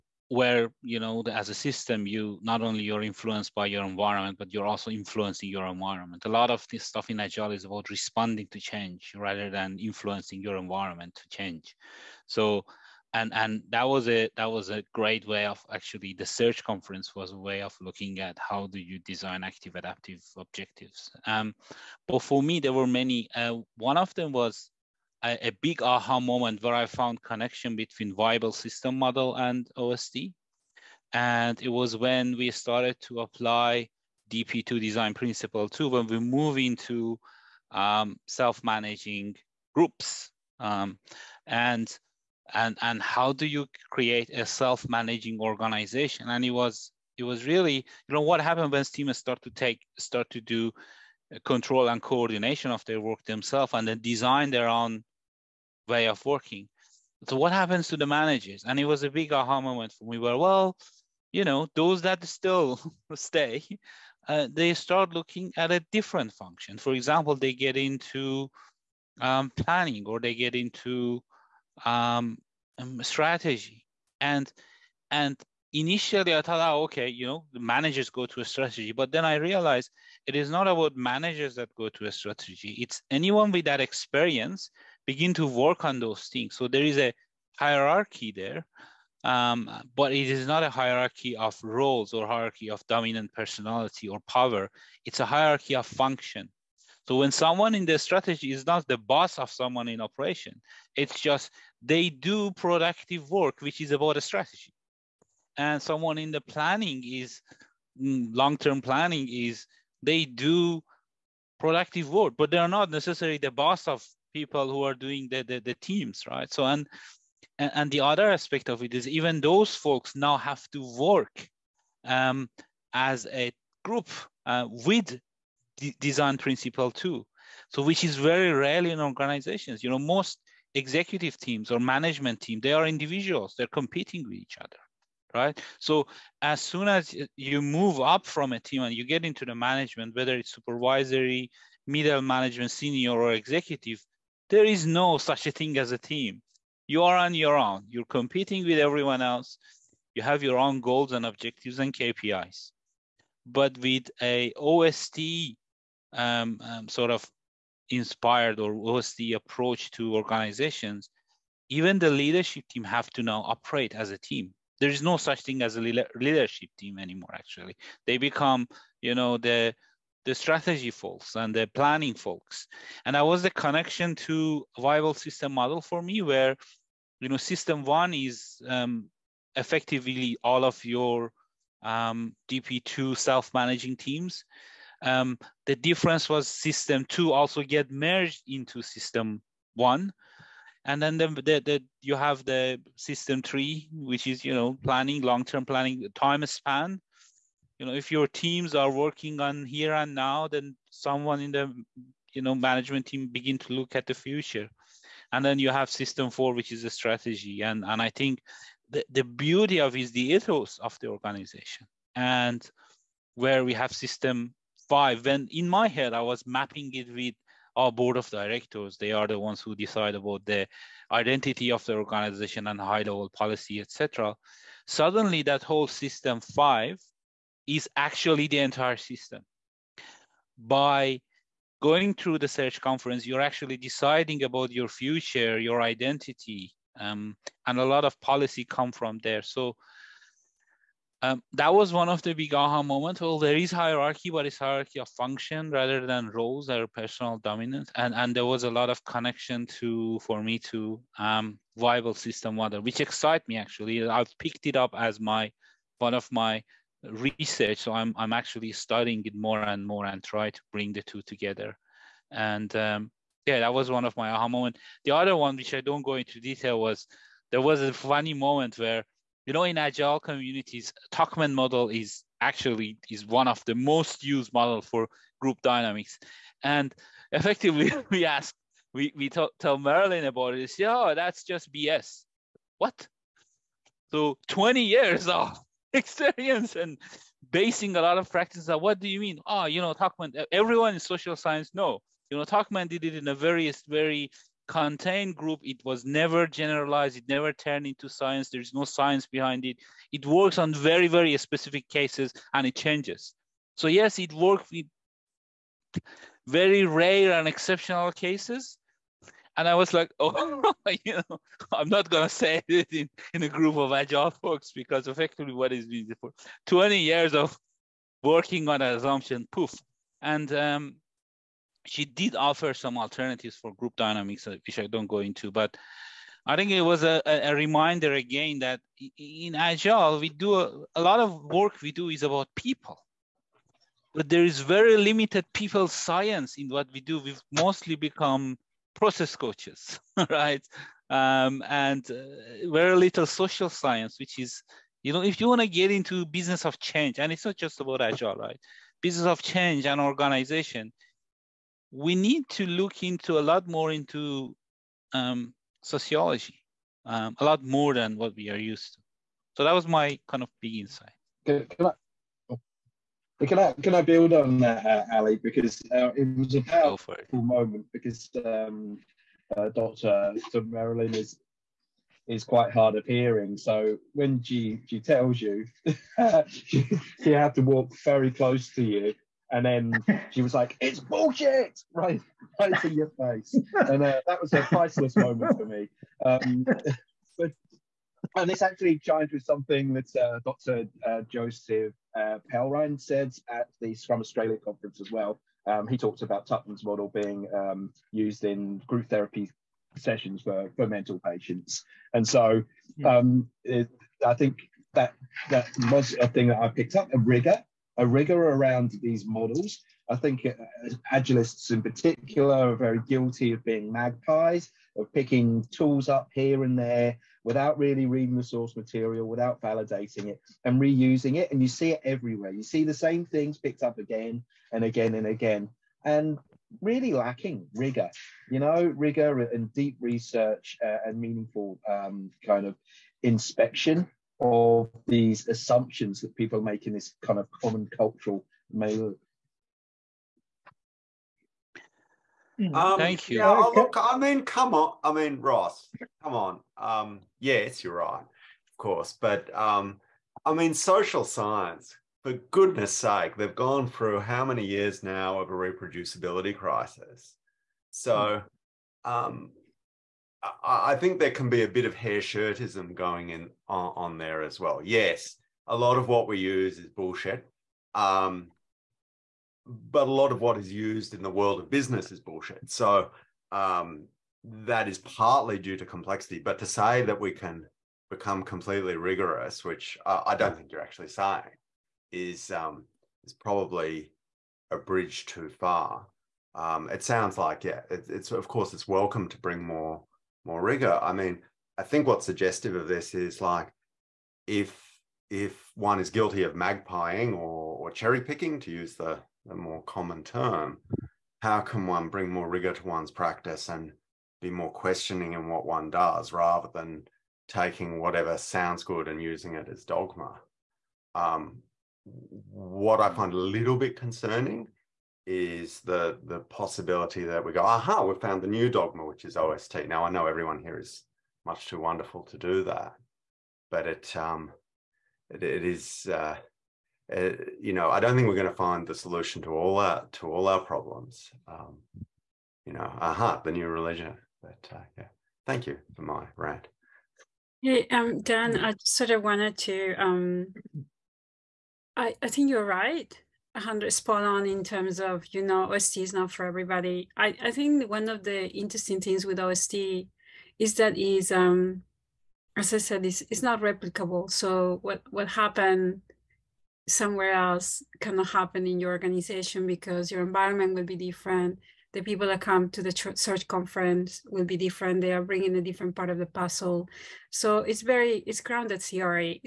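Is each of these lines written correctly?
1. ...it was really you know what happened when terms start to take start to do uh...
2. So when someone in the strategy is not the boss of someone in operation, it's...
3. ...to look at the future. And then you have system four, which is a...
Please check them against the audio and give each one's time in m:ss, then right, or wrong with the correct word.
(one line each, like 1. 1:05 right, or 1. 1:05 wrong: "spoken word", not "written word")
1. 0:47 wrong: "teams", not "terms"
2. 1:37 right
3. 3:23 right.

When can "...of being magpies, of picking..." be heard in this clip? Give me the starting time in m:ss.
6:53.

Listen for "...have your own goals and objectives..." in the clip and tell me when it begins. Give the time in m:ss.
2:30.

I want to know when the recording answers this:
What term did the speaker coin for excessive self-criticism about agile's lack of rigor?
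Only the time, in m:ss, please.
7:41.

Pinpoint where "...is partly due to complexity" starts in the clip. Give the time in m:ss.
7:54.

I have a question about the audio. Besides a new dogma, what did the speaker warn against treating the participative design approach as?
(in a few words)
the new religion.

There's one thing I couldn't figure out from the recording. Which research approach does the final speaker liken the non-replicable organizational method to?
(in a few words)
grounded theory.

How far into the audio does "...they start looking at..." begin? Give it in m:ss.
1:04.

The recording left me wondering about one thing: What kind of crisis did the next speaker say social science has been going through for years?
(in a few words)
reproducibility crisis.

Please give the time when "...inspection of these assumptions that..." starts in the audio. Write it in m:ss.
7:13.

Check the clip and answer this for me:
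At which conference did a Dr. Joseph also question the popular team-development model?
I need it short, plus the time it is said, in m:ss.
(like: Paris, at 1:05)
Scrum Australia, at 6:33.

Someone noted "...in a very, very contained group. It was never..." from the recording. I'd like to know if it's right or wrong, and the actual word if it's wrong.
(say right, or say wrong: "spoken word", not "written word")
right.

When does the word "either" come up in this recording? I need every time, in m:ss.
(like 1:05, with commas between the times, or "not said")
not said.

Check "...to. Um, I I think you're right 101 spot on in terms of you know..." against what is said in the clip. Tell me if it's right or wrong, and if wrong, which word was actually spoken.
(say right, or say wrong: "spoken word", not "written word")
wrong: "100", not "101".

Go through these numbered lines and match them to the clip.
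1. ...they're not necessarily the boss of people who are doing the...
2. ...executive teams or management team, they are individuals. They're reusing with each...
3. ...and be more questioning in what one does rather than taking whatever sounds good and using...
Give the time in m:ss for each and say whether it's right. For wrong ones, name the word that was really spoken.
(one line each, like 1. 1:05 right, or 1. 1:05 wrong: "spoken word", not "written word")
1. 1:52 right
2. 2:10 wrong: "competing", not "reusing"
3. 8:23 right.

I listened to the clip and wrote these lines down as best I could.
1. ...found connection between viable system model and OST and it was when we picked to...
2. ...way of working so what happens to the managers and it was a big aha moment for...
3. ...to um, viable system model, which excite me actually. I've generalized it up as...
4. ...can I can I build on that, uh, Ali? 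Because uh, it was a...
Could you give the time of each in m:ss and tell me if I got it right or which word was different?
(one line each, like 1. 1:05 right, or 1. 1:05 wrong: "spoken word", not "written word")
1. 0:26 wrong: "started", not "picked"
2. 0:55 right
3. 4:10 wrong: "picked", not "generalized"
4. 6:03 right.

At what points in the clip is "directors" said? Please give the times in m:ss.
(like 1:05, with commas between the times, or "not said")
3:38.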